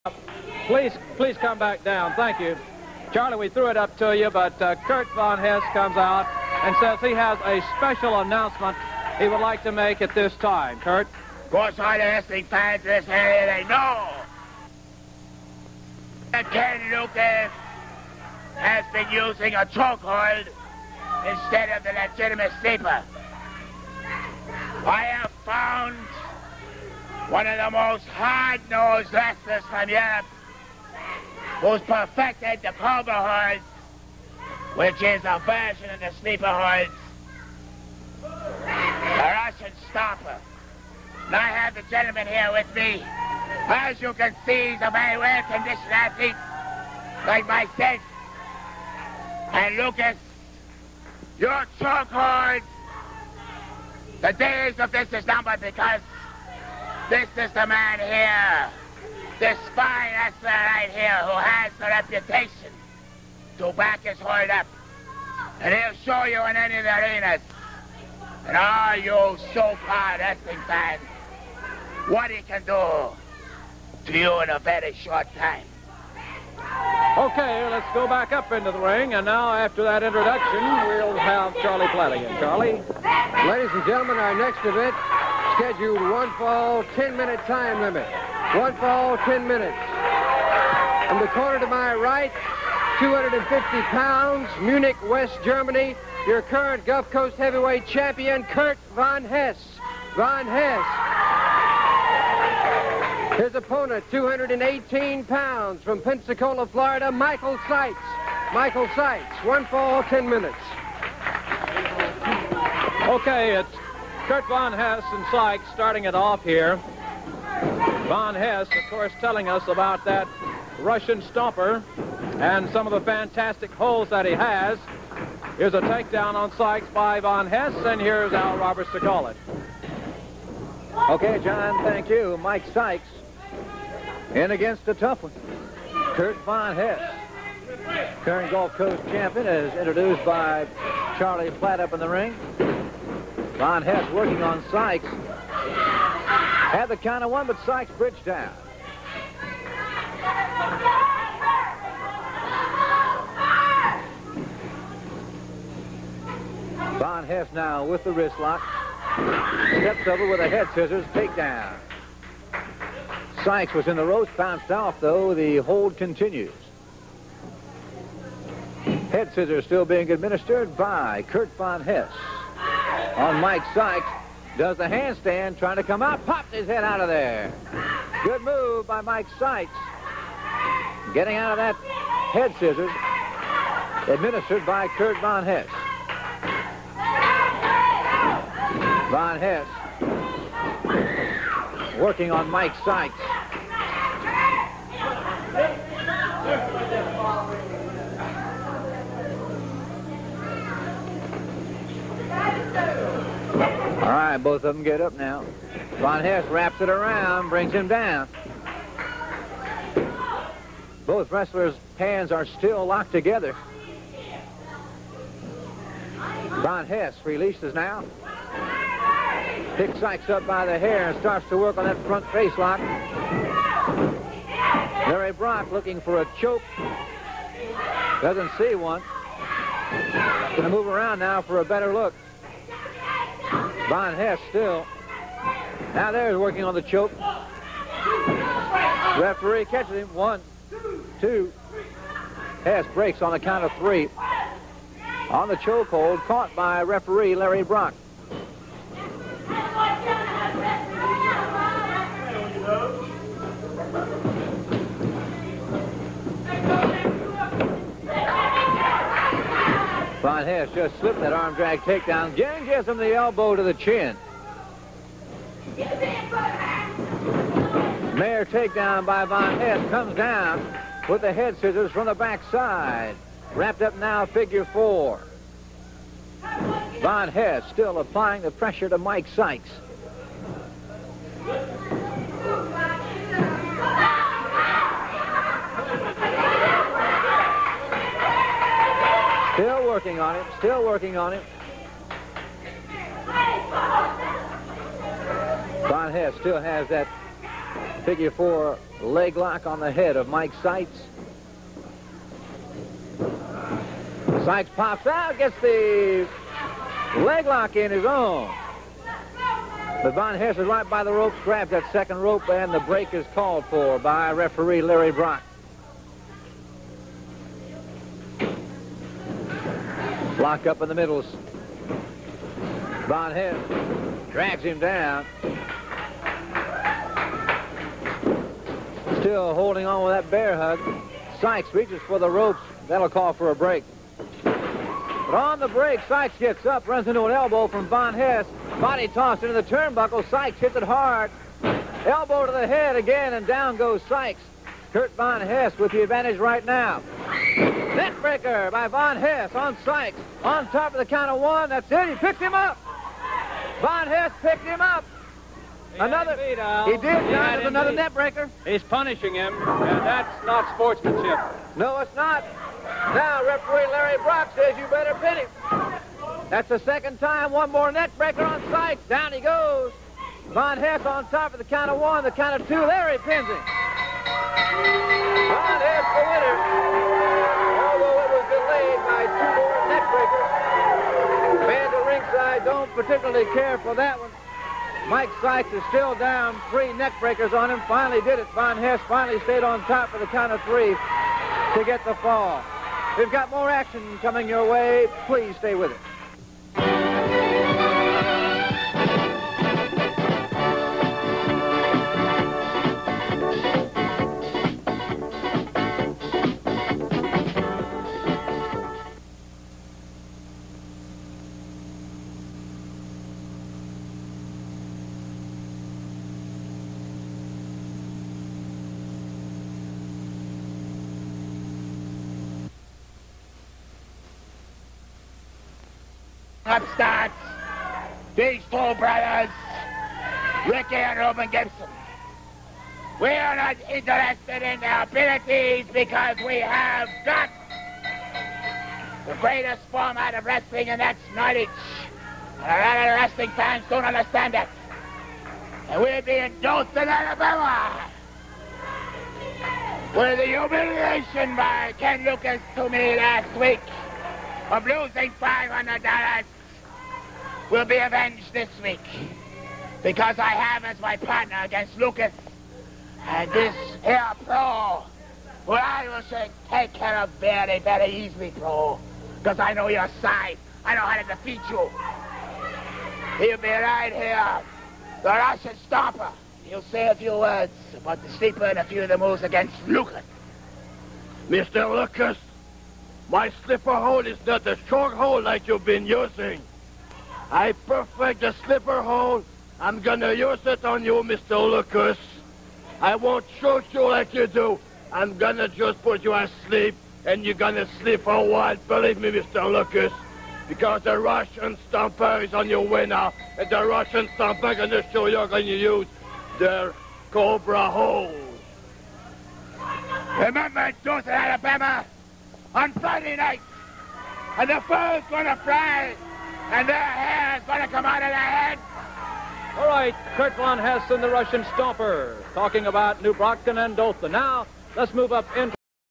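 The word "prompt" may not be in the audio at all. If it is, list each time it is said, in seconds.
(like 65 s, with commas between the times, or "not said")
not said.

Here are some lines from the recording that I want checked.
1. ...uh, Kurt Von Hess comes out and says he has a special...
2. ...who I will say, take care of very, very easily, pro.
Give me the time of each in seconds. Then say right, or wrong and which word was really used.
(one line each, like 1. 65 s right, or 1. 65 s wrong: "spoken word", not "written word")
1. 4 s right
2. 465 s right.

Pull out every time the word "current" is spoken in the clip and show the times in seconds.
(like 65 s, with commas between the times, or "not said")
96 s, 138 s.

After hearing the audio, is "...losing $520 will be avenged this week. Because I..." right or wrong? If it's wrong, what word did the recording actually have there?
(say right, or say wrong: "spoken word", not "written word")
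wrong: "500", not "520".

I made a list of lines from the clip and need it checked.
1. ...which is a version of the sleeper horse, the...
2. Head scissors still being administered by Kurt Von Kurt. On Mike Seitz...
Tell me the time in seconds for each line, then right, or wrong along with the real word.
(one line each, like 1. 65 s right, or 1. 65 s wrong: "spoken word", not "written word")
1. 34 s right
2. 169 s wrong: "Hess", not "Kurt".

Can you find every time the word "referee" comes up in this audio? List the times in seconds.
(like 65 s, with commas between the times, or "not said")
239 s, 246 s, 314 s, 363 s.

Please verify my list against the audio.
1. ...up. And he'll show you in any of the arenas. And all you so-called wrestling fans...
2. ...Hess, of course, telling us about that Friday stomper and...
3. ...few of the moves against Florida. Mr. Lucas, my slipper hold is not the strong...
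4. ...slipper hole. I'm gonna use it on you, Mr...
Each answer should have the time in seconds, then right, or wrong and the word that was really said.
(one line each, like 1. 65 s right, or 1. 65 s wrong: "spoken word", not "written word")
1. 64 s right
2. 118 s wrong: "Russian", not "Friday"
3. 478 s wrong: "Lucas", not "Florida"
4. 488 s right.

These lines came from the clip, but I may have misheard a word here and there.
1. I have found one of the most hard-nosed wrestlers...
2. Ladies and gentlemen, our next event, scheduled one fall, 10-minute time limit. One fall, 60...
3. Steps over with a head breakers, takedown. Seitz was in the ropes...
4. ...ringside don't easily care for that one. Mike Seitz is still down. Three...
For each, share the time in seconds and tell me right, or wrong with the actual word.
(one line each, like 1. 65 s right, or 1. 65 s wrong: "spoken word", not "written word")
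1. 24 s right
2. 83 s wrong: "10", not "60"
3. 159 s wrong: "scissors", not "breakers"
4. 382 s wrong: "particularly", not "easily".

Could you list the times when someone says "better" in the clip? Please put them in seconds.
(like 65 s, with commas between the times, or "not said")
231 s, 364 s.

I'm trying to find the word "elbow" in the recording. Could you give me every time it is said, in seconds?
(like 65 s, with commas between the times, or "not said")
263 s, 337 s, 342 s.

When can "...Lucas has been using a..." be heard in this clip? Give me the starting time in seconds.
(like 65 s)
16 s.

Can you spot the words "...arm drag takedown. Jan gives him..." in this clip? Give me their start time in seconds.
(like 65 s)
261 s.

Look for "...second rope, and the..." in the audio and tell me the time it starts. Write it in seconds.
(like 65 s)
311 s.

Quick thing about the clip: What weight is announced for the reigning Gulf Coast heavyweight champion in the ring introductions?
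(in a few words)
250 pounds.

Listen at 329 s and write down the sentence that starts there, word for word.
Still holding on with that bear hug.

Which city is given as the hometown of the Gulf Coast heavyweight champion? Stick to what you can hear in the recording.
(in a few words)
Munich, West Germany.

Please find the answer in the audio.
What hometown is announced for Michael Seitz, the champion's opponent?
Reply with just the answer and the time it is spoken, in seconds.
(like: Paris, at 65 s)
Pensacola, Florida, at 106 s.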